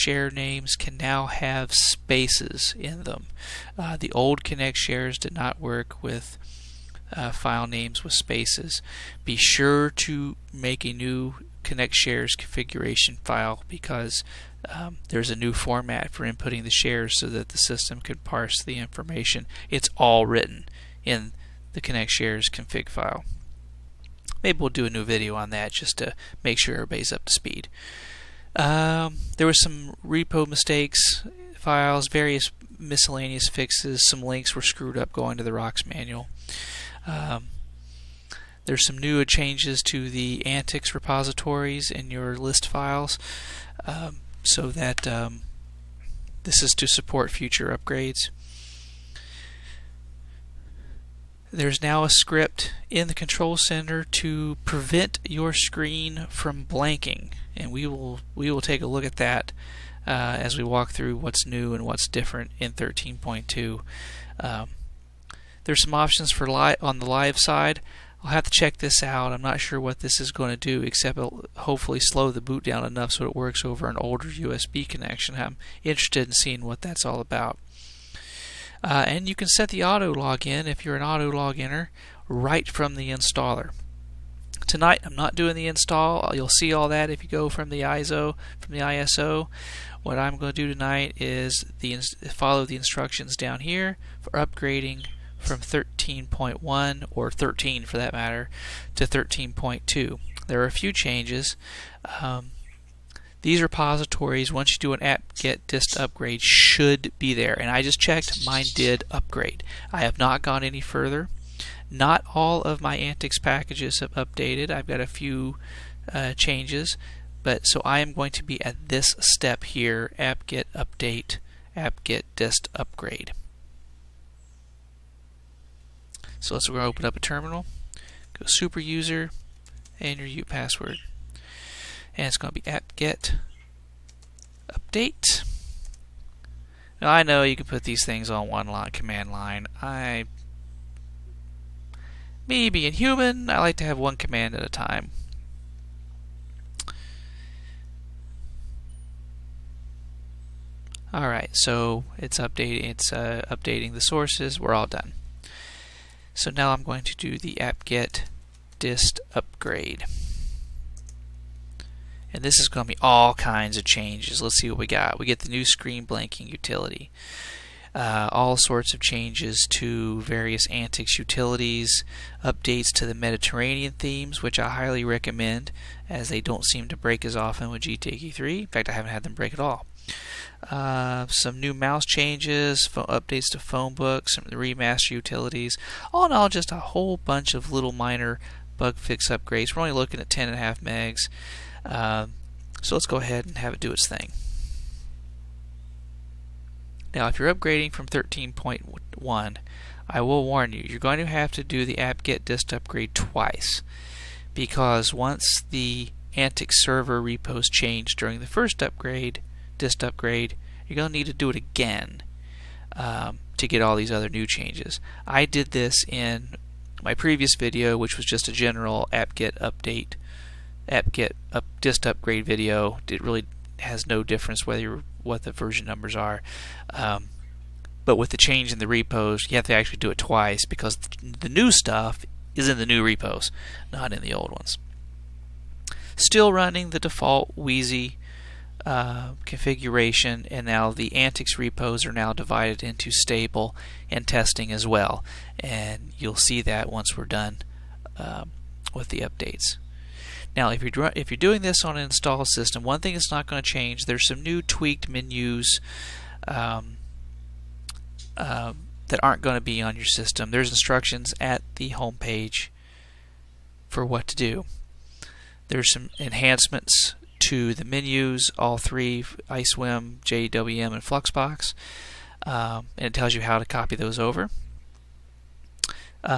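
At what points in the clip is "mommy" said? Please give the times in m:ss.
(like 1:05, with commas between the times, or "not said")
not said.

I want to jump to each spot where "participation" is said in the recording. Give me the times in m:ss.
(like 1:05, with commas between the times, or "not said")
not said.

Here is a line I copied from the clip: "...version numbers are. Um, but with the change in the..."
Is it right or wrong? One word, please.
right.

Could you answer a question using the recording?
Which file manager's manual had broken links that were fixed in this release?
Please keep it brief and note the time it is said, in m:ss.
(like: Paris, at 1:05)
ROX, at 0:35.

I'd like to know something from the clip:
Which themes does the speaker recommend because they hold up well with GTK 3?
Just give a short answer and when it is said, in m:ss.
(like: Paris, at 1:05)
Mediterranean, at 2:53.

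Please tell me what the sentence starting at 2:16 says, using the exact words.
Now I know you can put these things on one line command line.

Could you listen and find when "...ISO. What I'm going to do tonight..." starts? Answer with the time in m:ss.
1:28.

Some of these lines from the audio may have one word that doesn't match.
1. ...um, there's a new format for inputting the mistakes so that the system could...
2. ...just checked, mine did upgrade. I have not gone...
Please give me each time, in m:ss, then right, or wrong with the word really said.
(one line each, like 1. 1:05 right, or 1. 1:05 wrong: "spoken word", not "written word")
1. 0:14 wrong: "shares", not "mistakes"
2. 1:47 right.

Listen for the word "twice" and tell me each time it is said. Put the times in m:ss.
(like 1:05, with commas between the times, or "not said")
3:23, 3:50.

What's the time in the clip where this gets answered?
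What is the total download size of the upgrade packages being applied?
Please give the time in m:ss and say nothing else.
3:10.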